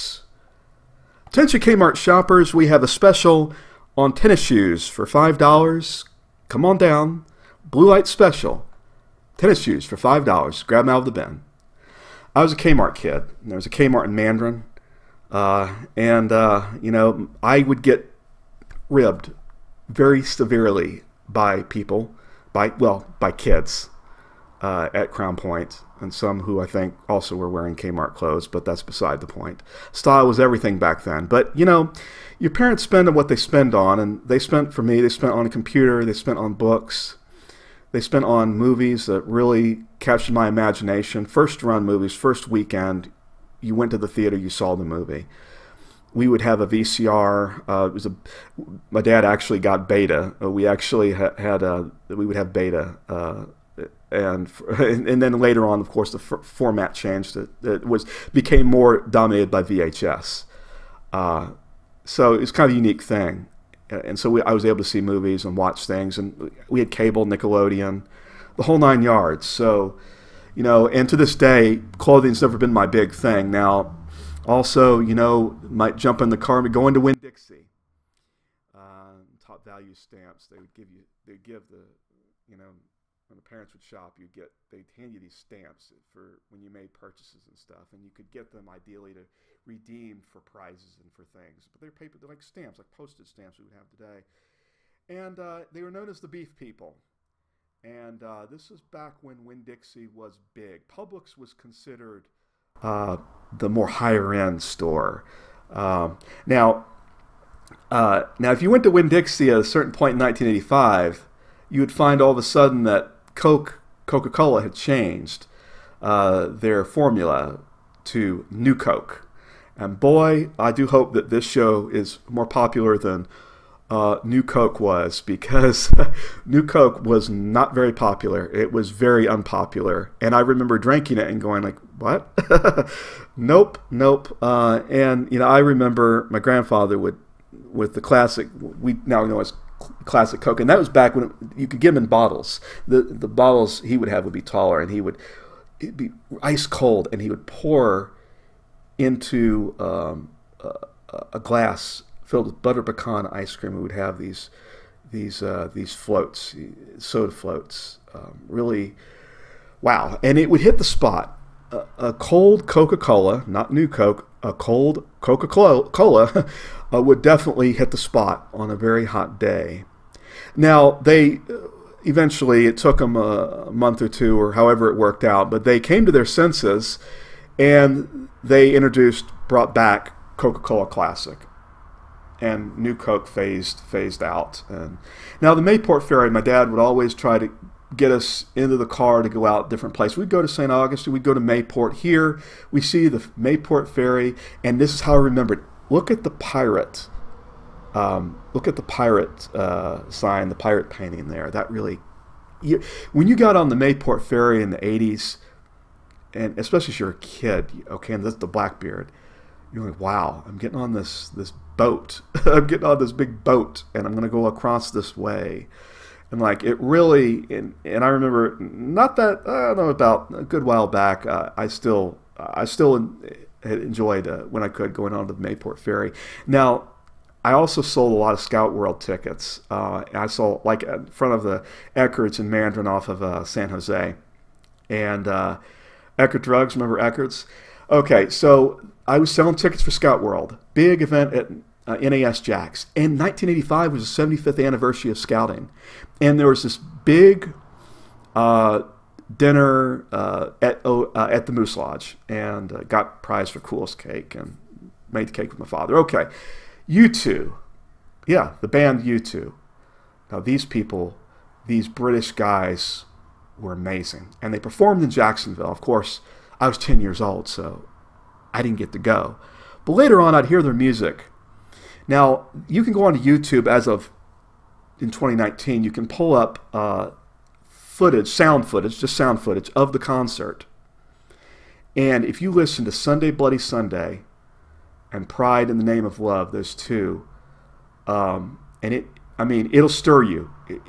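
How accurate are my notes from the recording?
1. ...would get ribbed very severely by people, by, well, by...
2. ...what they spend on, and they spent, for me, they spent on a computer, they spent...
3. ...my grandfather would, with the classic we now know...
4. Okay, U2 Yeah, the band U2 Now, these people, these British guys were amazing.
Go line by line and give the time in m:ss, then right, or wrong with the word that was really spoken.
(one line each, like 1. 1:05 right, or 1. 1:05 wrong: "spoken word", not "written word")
1. 0:17 right
2. 0:33 right
3. 2:16 right
4. 4:15 right.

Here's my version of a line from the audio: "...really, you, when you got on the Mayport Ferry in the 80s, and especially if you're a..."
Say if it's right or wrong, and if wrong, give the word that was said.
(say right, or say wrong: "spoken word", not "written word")
right.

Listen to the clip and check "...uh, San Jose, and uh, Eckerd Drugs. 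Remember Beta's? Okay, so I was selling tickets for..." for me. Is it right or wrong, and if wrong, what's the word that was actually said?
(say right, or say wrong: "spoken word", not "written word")
wrong: "Eckerd", not "Beta".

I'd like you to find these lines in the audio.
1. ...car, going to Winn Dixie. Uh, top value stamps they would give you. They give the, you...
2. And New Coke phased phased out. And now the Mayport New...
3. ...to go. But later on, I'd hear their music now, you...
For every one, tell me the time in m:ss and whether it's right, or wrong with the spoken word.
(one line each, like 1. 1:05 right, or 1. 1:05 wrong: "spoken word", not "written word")
1. 1:16 right
2. 3:02 wrong: "Ferry", not "New"
3. 4:28 right.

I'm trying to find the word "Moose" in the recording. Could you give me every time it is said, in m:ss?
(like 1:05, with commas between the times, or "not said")
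4:11.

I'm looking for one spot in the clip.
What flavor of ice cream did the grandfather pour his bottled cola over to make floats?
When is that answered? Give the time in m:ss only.
2:32.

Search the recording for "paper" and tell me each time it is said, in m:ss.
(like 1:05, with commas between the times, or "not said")
1:31.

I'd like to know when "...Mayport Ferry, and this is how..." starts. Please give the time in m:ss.
3:13.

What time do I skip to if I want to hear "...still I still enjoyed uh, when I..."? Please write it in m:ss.
3:41.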